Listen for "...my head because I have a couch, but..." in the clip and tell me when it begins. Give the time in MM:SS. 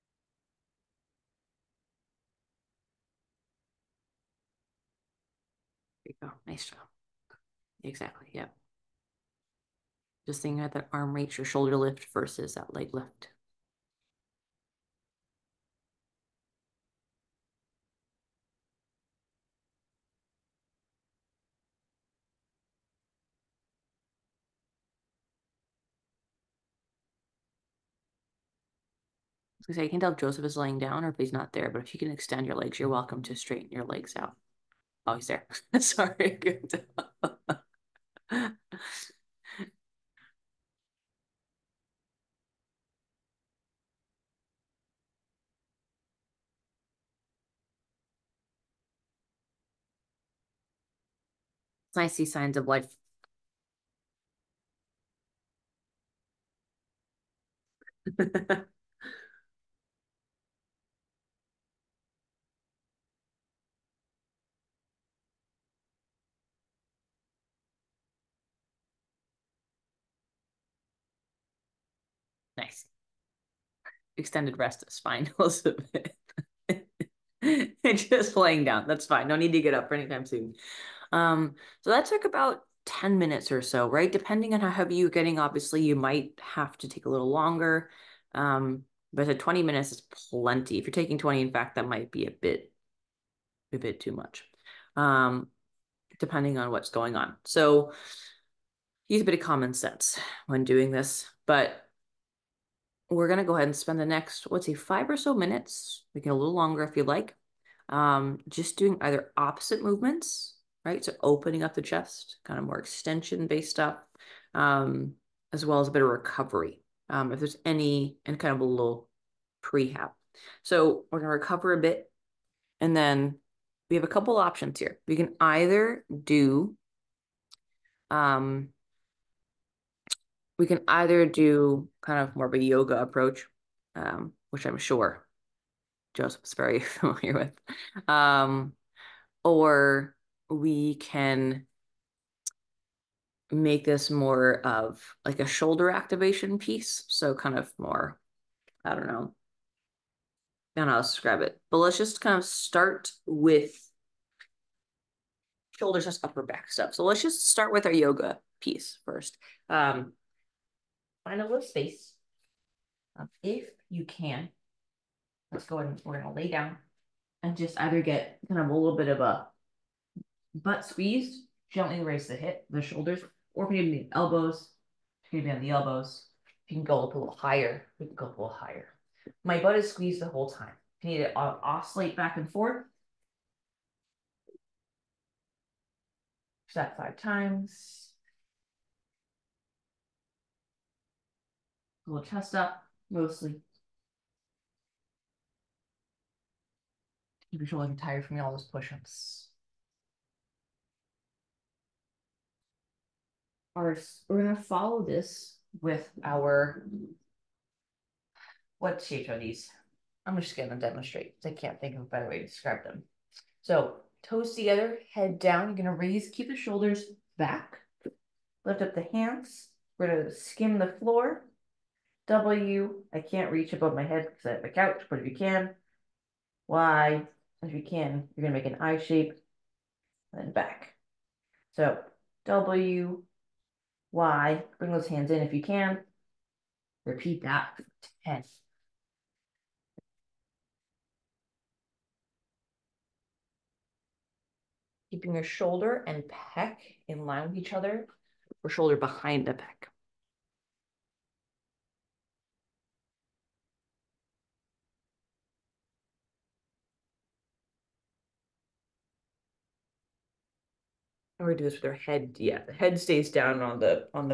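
03:43.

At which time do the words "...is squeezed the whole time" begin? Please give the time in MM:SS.
02:59.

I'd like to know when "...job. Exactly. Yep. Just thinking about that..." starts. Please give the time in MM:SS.
00:06.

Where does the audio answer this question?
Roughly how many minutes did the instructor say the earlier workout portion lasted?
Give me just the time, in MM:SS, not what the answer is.
01:22.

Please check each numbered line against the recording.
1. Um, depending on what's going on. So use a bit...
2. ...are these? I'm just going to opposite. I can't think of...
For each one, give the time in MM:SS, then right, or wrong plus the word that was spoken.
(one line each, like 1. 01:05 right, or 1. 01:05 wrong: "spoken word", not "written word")
1. 01:34 right
2. 03:29 wrong: "demonstrate", not "opposite".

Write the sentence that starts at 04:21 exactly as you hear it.
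we am gonna do this with our head.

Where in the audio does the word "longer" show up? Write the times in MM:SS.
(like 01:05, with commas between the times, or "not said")
01:27, 01:46.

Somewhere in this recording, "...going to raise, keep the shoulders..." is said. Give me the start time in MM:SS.
03:35.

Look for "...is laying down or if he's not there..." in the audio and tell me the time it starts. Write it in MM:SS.
00:30.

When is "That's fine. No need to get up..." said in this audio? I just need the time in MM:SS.
01:18.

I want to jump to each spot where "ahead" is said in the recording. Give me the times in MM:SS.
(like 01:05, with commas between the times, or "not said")
01:43, 02:45.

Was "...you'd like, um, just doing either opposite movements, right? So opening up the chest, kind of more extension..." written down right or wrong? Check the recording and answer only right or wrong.
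right.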